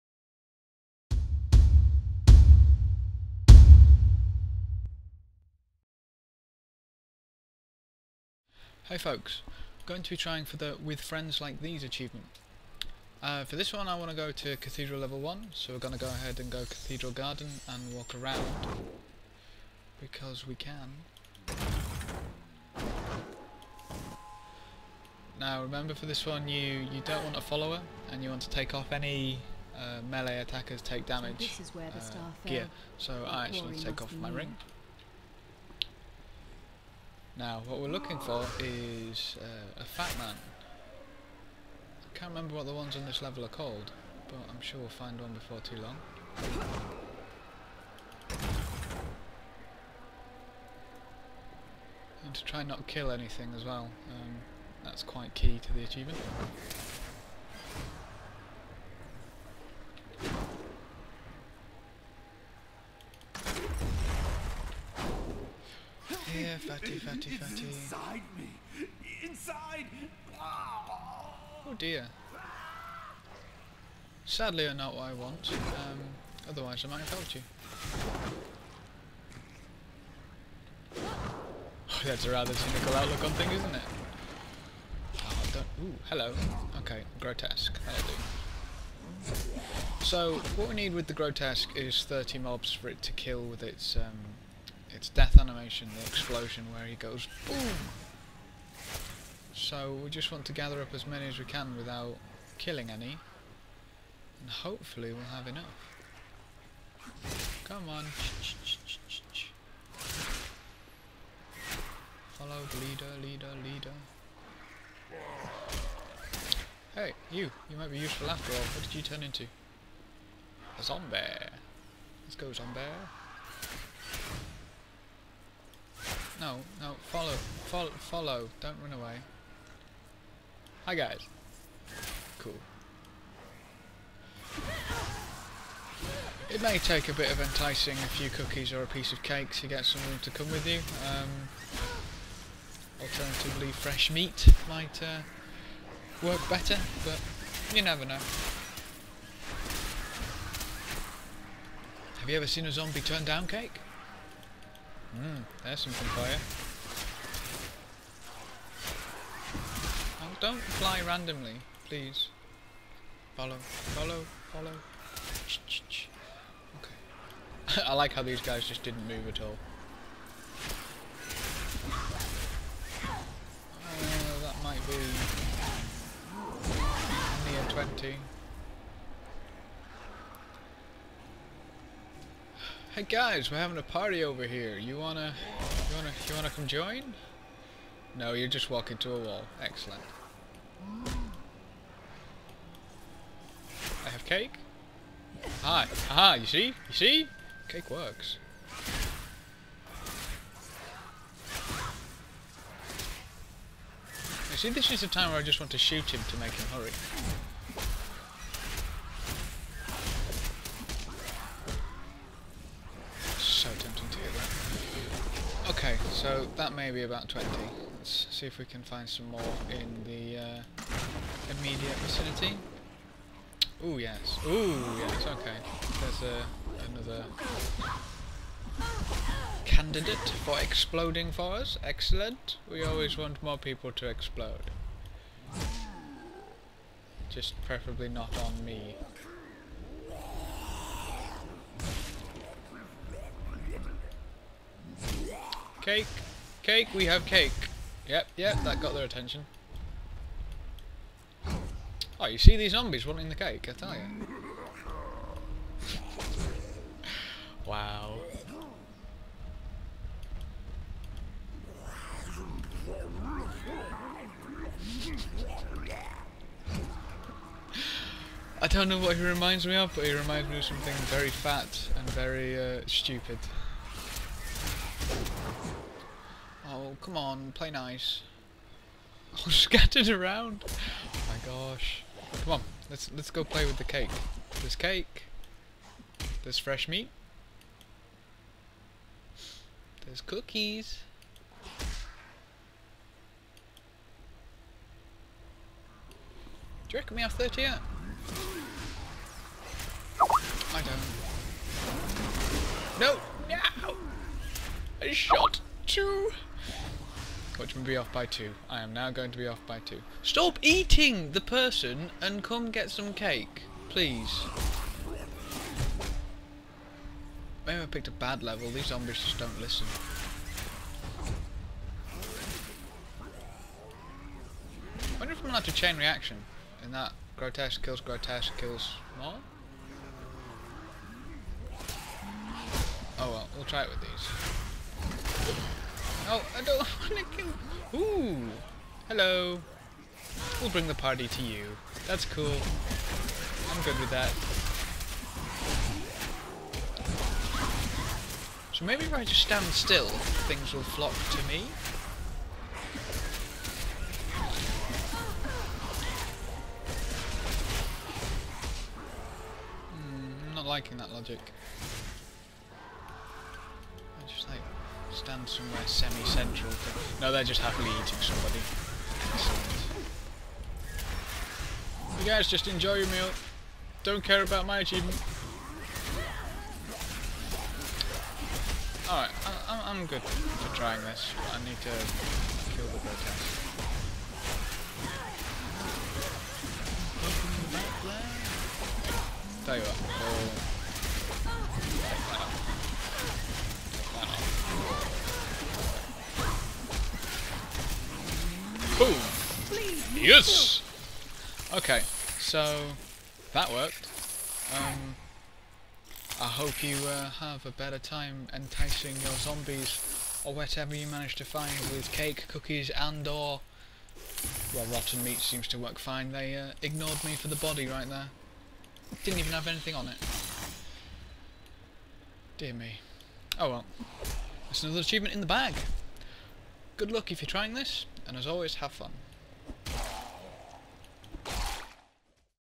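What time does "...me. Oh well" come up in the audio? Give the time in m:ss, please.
7:02.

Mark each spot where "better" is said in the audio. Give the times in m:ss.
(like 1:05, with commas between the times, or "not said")
2:26, 6:47.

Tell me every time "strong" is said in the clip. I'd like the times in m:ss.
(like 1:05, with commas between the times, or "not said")
not said.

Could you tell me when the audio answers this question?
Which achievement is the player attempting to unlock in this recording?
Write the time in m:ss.
0:10.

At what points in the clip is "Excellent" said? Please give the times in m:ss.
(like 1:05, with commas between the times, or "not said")
3:09, 3:51.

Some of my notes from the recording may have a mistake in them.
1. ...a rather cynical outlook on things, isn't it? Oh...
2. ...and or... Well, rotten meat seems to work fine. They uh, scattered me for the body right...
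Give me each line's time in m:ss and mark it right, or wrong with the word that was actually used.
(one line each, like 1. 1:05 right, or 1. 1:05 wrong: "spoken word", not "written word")
1. 1:22 right
2. 6:52 wrong: "ignored", not "scattered".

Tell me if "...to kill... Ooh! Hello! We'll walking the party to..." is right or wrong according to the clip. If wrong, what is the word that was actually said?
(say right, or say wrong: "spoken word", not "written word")
wrong: "bring", not "walking".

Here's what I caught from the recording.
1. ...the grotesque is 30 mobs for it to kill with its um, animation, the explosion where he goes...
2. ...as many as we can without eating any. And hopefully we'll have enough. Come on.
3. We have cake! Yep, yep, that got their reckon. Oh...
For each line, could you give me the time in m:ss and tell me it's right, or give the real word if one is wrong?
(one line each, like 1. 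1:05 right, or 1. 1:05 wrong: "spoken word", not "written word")
1. 1:31 right
2. 1:40 wrong: "killing", not "eating"
3. 4:06 wrong: "attention", not "reckon".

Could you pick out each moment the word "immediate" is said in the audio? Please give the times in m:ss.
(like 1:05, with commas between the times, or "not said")
3:41.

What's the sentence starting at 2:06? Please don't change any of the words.
No, no, follow, follow, follow, don't run away.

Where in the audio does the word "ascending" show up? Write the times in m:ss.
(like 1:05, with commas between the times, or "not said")
not said.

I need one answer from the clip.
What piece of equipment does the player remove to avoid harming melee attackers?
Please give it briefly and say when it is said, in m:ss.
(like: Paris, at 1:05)
ring, at 0:34.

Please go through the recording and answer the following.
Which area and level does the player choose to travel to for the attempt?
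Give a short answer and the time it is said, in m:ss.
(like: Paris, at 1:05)
Cathedral Level 1, at 0:14.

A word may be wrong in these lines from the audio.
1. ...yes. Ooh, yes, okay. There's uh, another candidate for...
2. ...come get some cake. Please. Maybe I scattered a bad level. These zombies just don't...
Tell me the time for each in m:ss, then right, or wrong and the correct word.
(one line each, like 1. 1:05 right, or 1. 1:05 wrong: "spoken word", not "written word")
1. 3:43 right
2. 5:12 wrong: "picked", not "scattered".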